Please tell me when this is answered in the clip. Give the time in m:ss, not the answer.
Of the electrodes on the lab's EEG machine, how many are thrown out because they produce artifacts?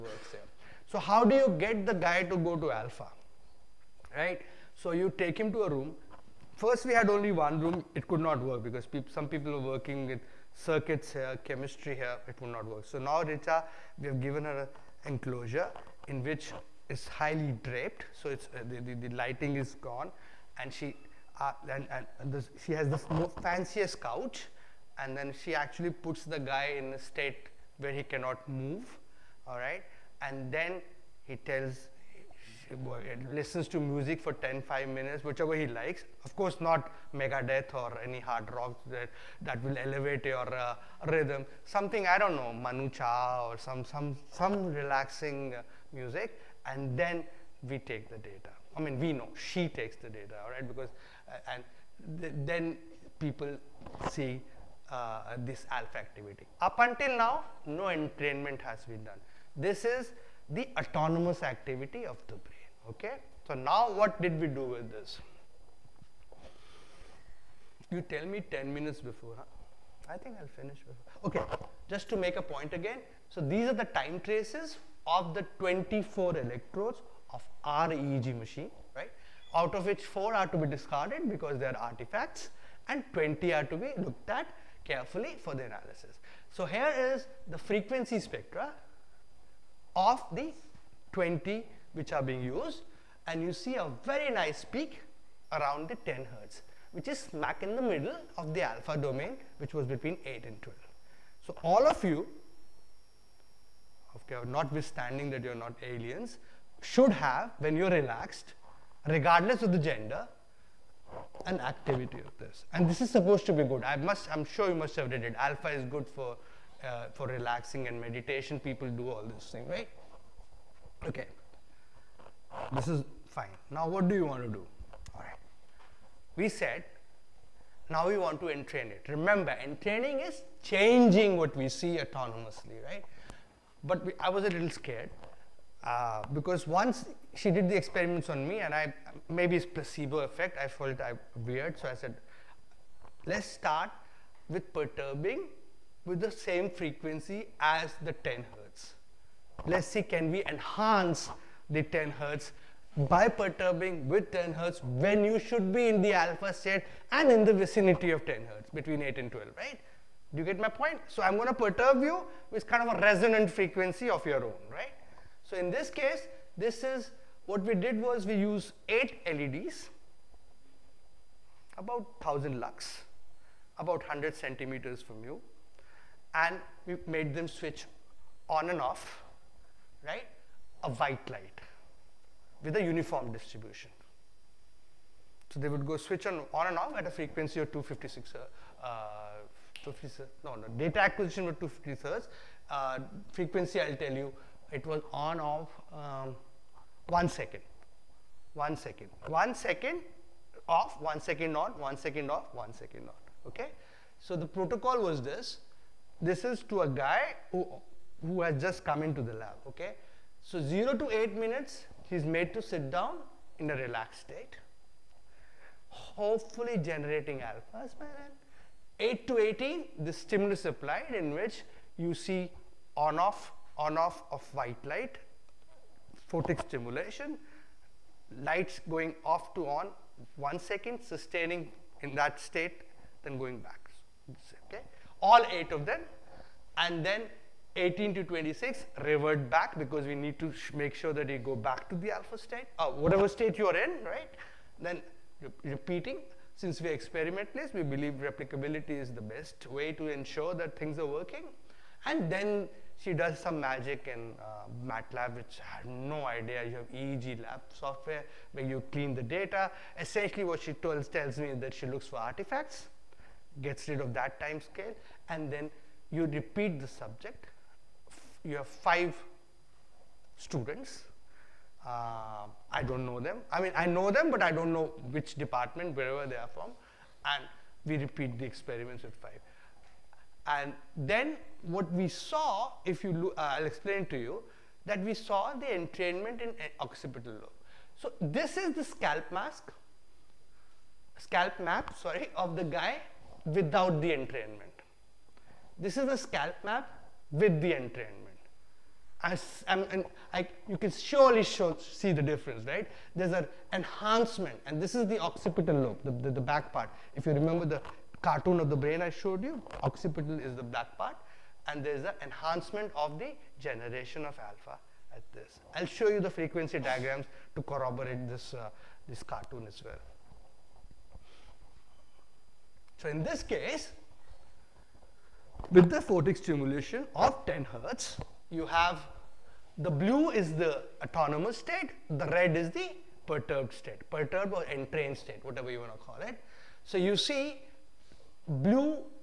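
1:20.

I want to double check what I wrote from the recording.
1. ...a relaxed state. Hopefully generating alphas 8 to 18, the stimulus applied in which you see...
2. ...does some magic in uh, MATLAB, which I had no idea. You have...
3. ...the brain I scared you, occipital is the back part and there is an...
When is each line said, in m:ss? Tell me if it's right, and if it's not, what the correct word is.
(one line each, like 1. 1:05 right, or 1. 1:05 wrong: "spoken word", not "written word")
1. 3:33 right
2. 4:13 right
3. 5:08 wrong: "showed", not "scared".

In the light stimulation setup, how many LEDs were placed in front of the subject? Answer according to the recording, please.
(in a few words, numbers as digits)
8.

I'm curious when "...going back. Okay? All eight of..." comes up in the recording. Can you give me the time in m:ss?
3:53.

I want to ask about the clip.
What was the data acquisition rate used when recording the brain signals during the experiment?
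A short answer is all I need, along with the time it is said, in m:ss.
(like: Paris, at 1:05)
250 hertz, at 3:11.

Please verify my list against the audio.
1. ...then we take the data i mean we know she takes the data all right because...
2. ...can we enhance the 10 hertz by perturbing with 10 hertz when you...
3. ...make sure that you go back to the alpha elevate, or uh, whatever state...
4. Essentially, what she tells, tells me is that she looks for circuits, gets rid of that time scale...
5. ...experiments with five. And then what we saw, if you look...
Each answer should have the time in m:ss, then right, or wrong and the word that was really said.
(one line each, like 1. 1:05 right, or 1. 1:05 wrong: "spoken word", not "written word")
1. 0:46 right
2. 2:30 right
3. 4:00 wrong: "state", not "elevate"
4. 4:19 wrong: "artifacts", not "circuits"
5. 4:38 right.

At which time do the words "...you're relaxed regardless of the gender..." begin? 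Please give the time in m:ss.
1:47.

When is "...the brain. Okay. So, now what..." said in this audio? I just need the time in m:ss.
1:02.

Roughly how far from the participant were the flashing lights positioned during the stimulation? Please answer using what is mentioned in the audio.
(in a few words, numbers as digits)
100 centimeters.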